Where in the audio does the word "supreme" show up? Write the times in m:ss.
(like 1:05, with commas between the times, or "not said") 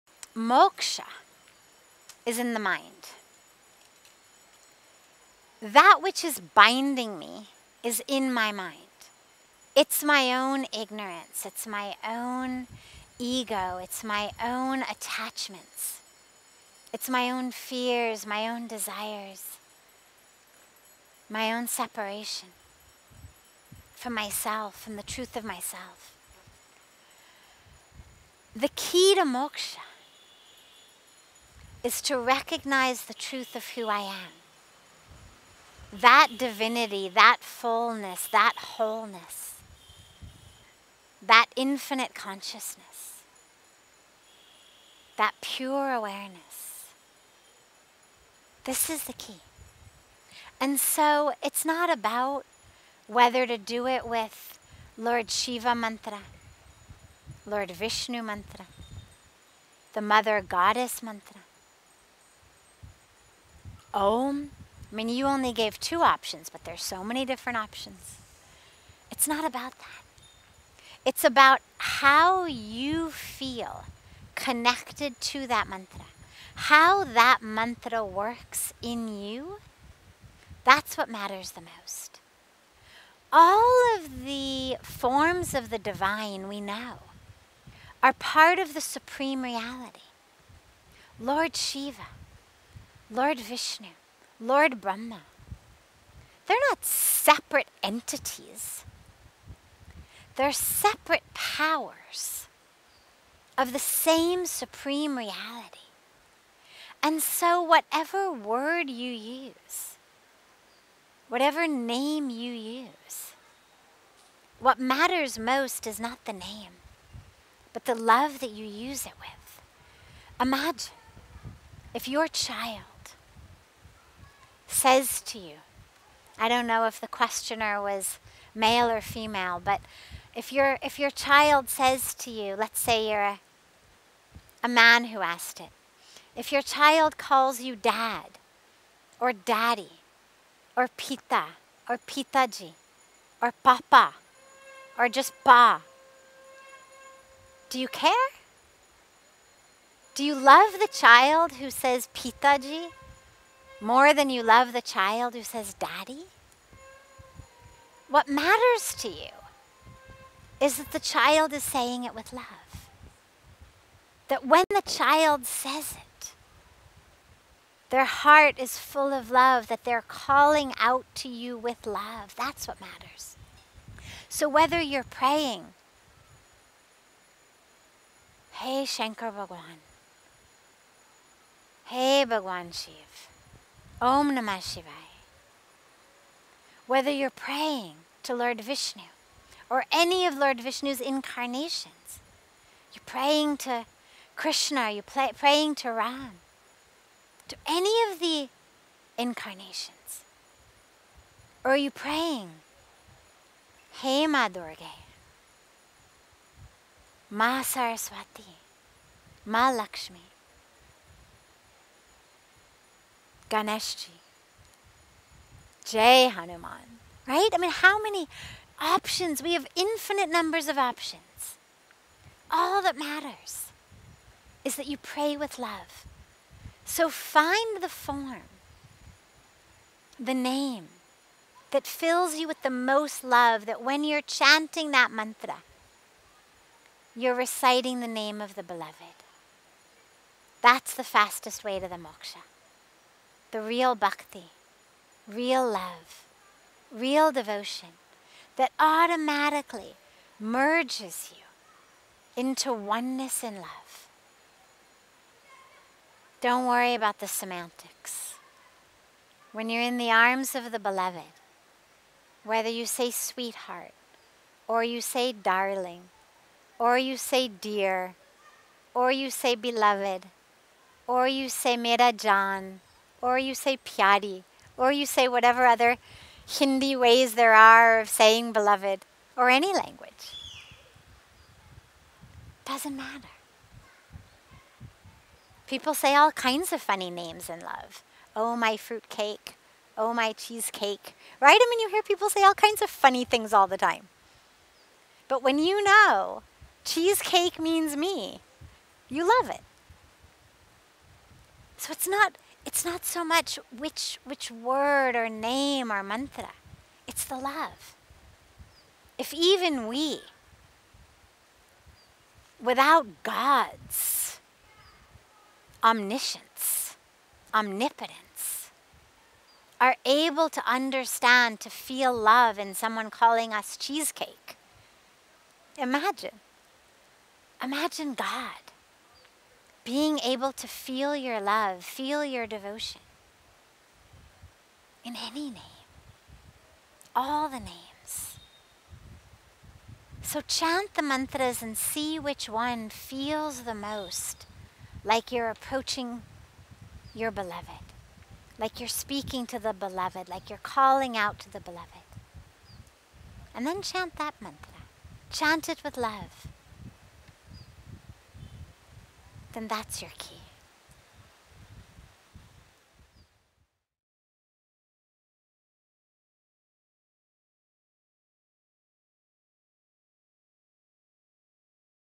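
1:28, 1:44.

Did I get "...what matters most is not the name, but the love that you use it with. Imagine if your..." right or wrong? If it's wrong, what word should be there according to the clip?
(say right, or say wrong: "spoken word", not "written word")
right.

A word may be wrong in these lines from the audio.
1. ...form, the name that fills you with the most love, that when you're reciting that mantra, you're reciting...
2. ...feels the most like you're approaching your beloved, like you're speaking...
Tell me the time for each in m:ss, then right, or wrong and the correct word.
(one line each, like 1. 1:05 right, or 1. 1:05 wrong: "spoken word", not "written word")
1. 3:47 wrong: "chanting", not "reciting"
2. 5:42 right.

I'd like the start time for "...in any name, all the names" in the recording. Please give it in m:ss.
5:35.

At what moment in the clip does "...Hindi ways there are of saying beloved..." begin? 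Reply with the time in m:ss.
4:36.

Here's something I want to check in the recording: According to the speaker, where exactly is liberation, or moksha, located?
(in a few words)
In the mind.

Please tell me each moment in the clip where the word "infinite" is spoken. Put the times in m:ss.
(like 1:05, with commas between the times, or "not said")
0:41, 3:39.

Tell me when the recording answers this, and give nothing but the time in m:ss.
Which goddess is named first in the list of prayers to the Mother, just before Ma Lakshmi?
3:27.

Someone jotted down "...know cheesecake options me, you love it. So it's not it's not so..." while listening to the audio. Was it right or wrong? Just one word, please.
wrong.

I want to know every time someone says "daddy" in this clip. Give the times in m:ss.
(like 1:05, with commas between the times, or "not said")
2:19, 2:35.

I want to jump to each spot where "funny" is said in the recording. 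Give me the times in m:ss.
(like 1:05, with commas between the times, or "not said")
4:46, 4:52.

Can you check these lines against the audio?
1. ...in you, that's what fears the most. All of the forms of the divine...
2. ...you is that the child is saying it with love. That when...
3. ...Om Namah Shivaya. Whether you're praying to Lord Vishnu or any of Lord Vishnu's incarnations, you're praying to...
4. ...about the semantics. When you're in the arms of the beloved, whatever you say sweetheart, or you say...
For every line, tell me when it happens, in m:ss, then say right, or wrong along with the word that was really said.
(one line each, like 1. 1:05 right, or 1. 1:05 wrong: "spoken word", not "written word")
1. 1:18 wrong: "matters", not "fears"
2. 2:39 right
3. 3:04 right
4. 4:16 wrong: "whether", not "whatever".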